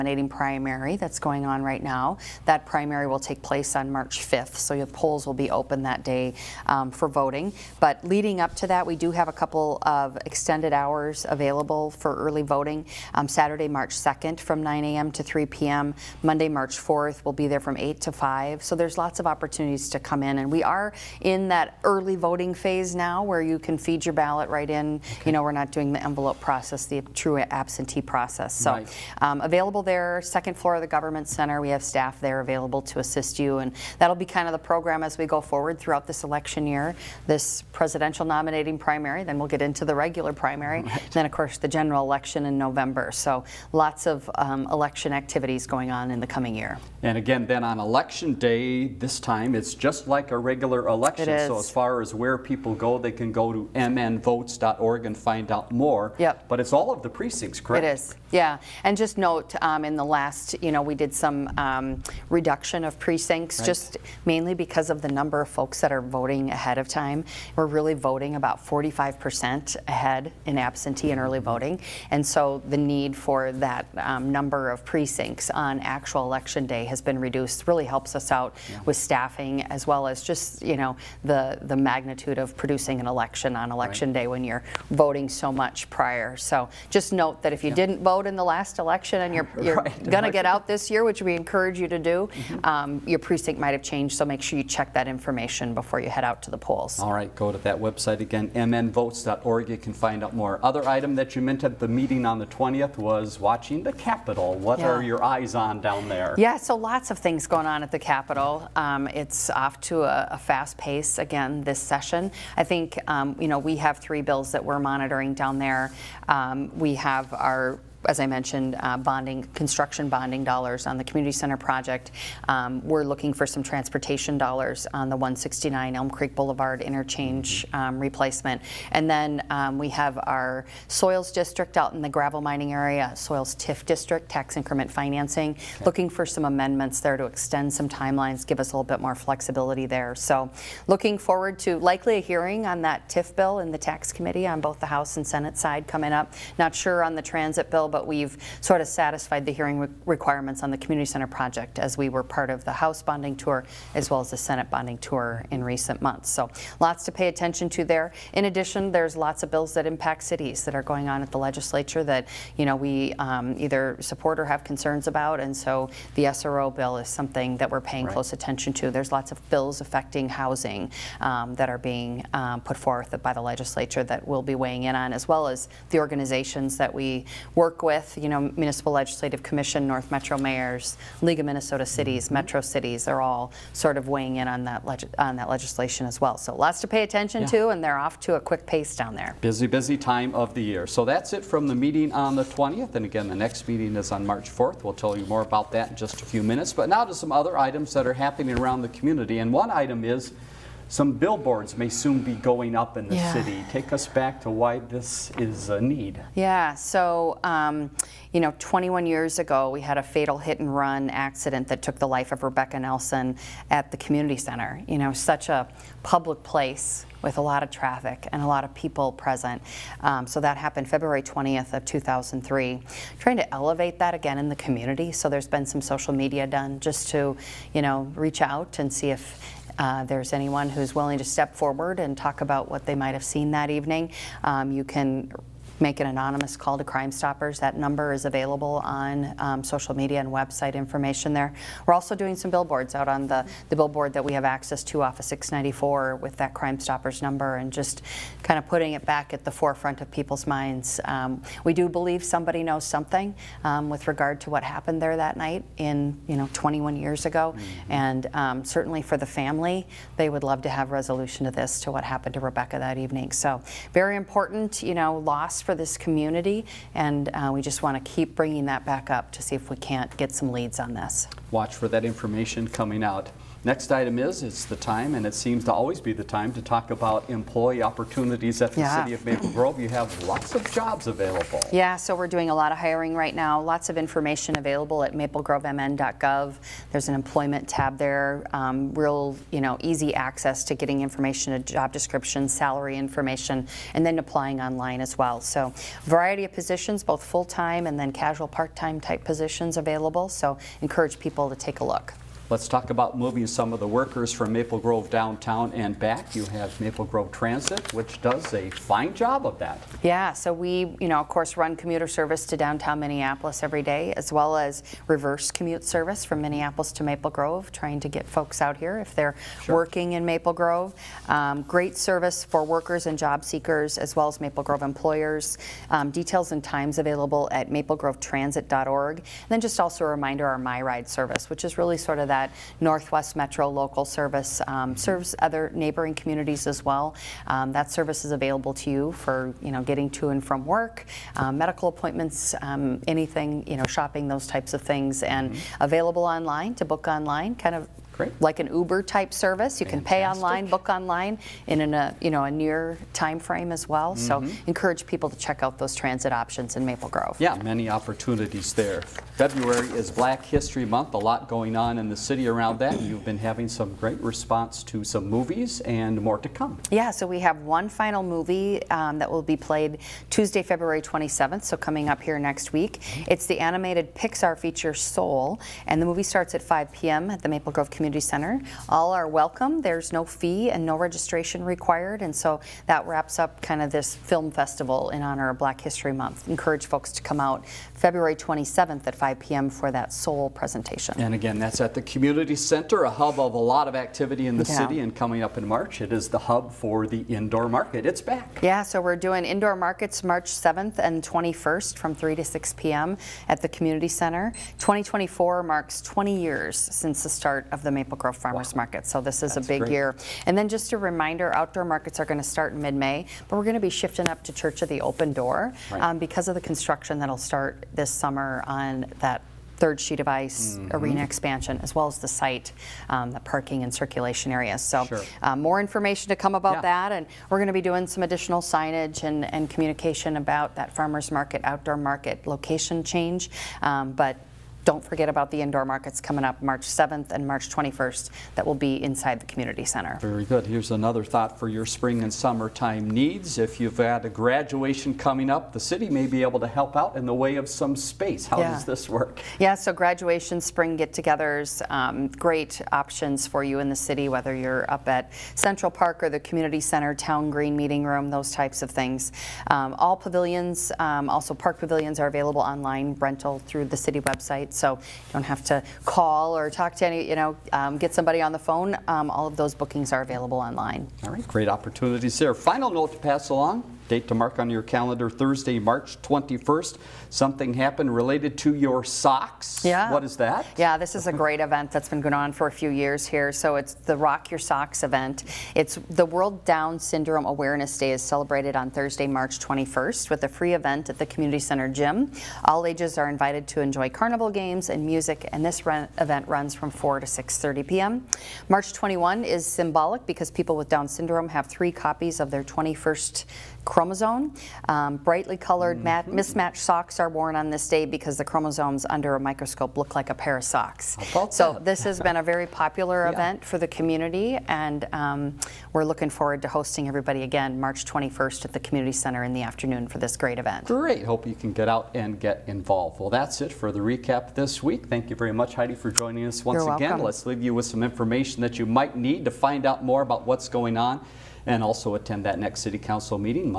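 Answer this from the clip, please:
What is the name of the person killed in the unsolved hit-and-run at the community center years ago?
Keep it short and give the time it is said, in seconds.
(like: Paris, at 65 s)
Rebecca Nelson, at 212 s.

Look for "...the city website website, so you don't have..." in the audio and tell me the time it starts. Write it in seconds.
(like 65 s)
463 s.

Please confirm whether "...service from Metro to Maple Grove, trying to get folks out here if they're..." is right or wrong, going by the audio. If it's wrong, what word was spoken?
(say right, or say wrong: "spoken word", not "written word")
wrong: "Minneapolis", not "Metro".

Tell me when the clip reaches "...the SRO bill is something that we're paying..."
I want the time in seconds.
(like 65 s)
166 s.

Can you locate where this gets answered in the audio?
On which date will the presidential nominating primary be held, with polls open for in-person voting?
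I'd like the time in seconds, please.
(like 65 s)
3 s.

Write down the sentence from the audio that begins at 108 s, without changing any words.
Um, it's off to a, a, fast pace again this session.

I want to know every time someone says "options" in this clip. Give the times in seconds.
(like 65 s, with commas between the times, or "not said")
356 s, 452 s.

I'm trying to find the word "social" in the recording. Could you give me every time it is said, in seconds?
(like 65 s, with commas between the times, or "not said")
225 s, 239 s.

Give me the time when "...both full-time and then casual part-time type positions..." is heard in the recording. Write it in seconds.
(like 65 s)
297 s.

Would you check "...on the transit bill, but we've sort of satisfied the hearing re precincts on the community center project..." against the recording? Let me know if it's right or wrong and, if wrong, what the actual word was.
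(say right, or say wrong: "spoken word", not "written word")
wrong: "requirements", not "precincts".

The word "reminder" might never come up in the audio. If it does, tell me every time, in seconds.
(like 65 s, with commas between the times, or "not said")
330 s, 410 s.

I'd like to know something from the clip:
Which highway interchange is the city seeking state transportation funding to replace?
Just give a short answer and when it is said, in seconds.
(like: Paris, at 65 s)
169 Elm Creek Boulevard, at 125 s.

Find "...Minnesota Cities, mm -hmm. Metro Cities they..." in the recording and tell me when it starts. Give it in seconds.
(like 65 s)
181 s.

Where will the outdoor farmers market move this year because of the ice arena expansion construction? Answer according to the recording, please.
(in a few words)
Church of the Open Door.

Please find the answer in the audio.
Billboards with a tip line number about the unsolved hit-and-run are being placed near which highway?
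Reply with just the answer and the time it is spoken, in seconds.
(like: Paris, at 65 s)
694, at 245 s.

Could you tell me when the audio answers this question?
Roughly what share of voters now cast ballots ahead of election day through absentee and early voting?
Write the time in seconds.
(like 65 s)
68 s.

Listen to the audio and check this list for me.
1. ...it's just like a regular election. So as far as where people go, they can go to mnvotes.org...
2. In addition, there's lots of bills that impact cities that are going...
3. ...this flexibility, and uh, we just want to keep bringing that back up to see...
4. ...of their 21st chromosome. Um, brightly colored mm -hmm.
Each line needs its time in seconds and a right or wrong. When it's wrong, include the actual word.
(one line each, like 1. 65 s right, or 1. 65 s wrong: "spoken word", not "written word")
1. 49 s right
2. 158 s right
3. 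265 s wrong: "community", not "flexibility"
4. 502 s right.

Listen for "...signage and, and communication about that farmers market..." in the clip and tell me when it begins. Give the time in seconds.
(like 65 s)
428 s.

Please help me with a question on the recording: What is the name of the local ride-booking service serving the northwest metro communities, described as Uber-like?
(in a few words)
MyRide.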